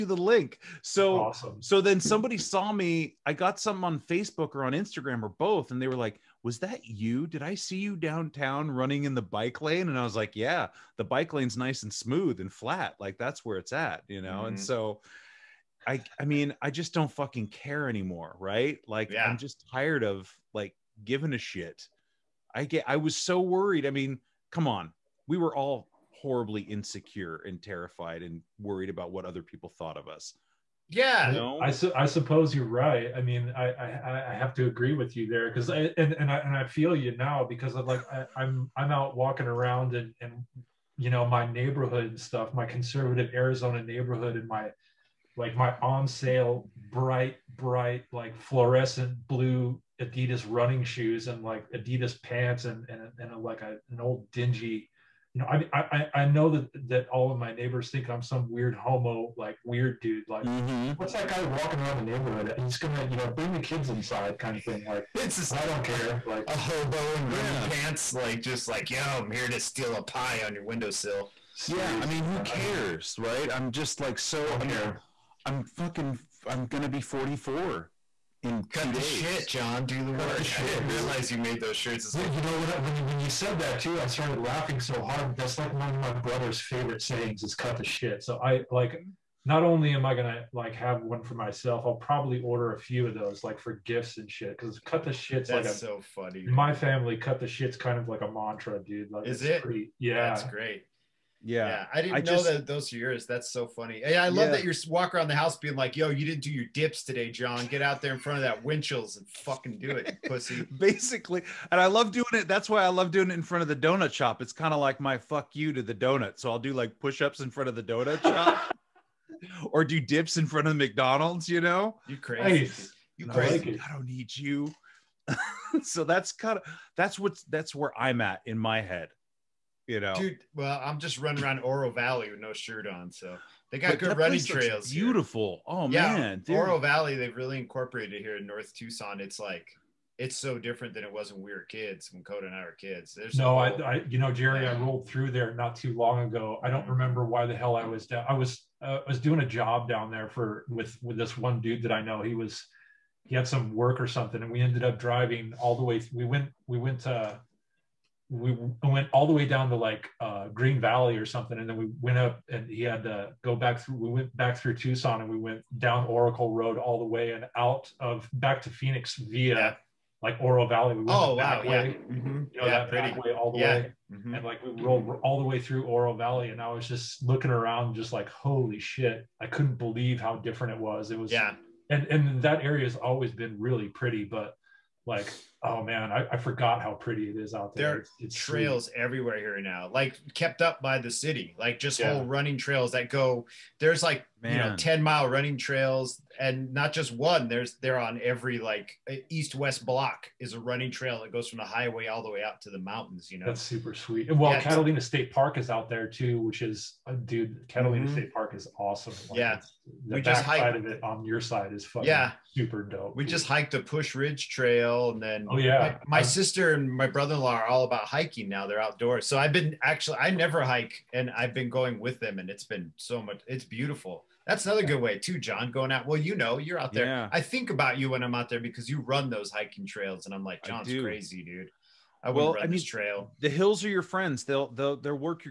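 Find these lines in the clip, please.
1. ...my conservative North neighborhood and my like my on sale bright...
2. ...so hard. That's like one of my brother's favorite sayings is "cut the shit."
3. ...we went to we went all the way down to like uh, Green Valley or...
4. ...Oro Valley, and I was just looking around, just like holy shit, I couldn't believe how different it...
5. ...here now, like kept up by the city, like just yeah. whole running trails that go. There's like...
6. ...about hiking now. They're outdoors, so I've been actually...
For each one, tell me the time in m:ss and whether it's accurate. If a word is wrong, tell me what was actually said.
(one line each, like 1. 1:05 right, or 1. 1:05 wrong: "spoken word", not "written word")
1. 0:42 wrong: "Arizona", not "North"
2. 1:24 right
3. 2:36 right
4. 2:55 right
5. 3:09 right
6. 3:37 right.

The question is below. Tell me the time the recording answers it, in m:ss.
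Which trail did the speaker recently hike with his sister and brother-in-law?
3:33.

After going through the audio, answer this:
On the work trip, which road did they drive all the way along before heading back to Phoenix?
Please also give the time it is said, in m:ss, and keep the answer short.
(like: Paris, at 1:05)
Oracle Road, at 2:46.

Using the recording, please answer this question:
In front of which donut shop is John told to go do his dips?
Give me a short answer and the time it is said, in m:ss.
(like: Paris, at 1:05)
Winchell's, at 1:48.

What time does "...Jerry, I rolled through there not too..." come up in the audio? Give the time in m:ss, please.
2:24.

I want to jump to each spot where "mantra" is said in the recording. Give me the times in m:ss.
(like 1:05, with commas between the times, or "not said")
1:38.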